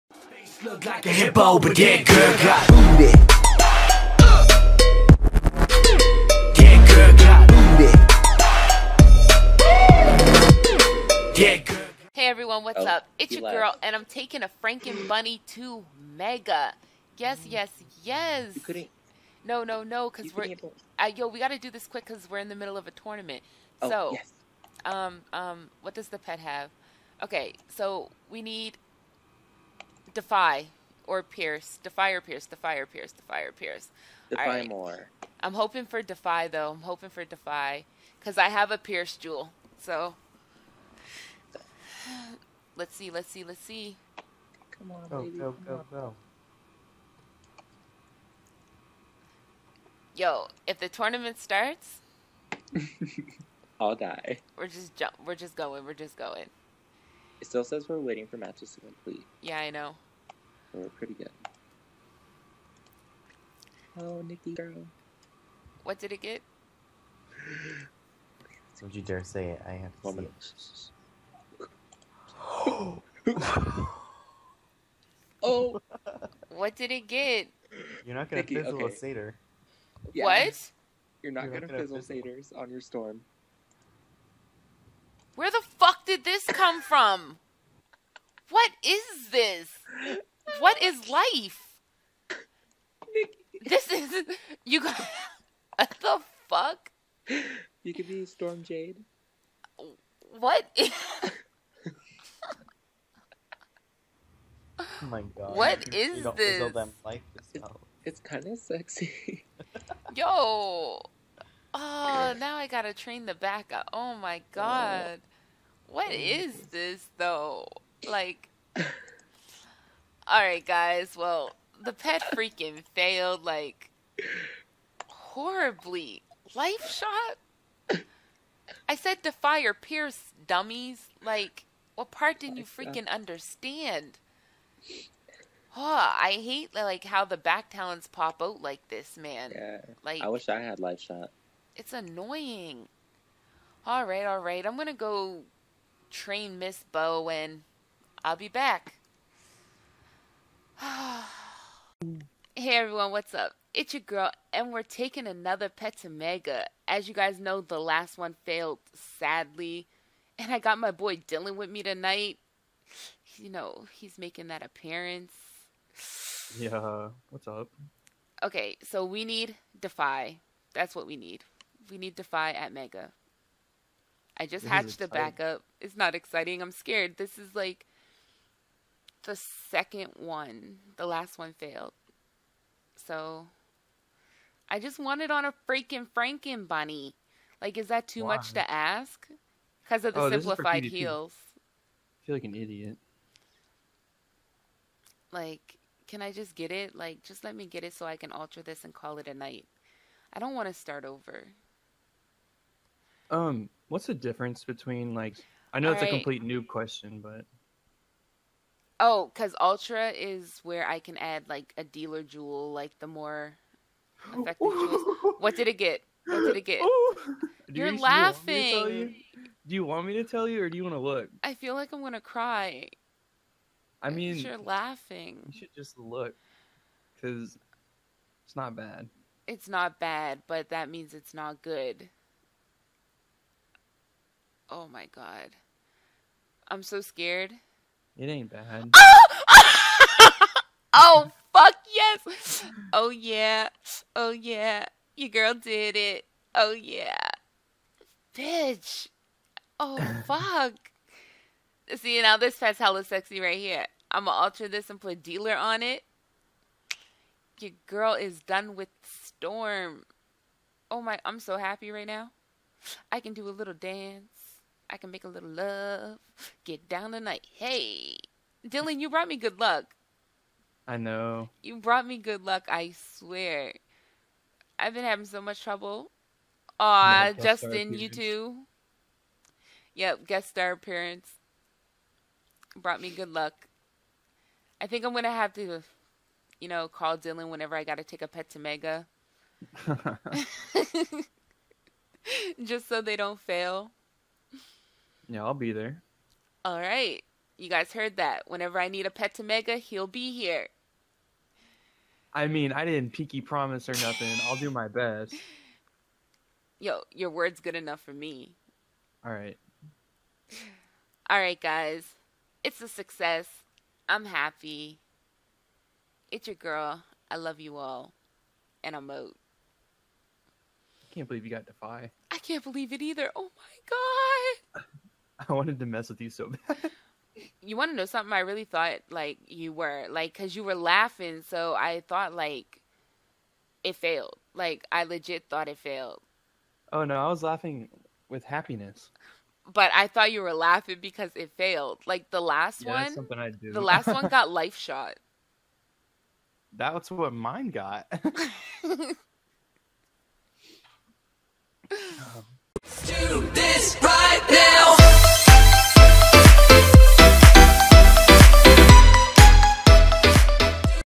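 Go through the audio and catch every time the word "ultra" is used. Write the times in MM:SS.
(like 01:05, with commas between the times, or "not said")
03:29.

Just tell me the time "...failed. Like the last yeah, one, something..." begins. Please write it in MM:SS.
05:41.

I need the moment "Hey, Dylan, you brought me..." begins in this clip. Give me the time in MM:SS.
04:27.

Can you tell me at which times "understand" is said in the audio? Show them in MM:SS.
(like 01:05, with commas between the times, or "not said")
02:13.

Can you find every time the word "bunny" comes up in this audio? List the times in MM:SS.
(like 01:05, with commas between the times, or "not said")
00:15, 03:06.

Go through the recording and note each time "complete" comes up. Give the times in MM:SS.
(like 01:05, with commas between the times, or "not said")
00:58, 03:26.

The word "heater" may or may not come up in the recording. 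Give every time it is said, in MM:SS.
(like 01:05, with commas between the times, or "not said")
not said.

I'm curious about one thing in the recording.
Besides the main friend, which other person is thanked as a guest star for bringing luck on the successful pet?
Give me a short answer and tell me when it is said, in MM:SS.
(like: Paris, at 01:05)
Justin, at 04:37.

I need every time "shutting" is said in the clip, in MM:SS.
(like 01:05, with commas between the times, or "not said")
not said.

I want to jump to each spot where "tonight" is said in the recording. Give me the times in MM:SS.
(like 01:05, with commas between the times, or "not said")
02:41, 04:27.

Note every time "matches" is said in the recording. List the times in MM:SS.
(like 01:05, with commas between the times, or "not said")
00:58.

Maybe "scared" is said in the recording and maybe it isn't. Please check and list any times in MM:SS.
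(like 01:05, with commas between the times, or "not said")
02:56, 03:57.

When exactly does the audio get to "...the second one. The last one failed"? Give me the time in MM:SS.
02:59.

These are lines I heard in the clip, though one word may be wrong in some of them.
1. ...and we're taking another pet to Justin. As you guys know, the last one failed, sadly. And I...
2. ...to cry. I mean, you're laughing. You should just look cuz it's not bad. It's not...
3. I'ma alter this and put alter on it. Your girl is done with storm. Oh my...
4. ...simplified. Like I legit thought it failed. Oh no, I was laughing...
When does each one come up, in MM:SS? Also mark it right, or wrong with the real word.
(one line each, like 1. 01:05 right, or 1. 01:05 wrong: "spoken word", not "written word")
1. 02:34 wrong: "Mega", not "Justin"
2. 03:42 right
3. 04:14 wrong: "dealer", not "alter"
4. 05:33 wrong: "failed", not "simplified".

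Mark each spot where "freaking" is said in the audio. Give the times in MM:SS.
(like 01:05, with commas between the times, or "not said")
02:02, 02:12, 03:05.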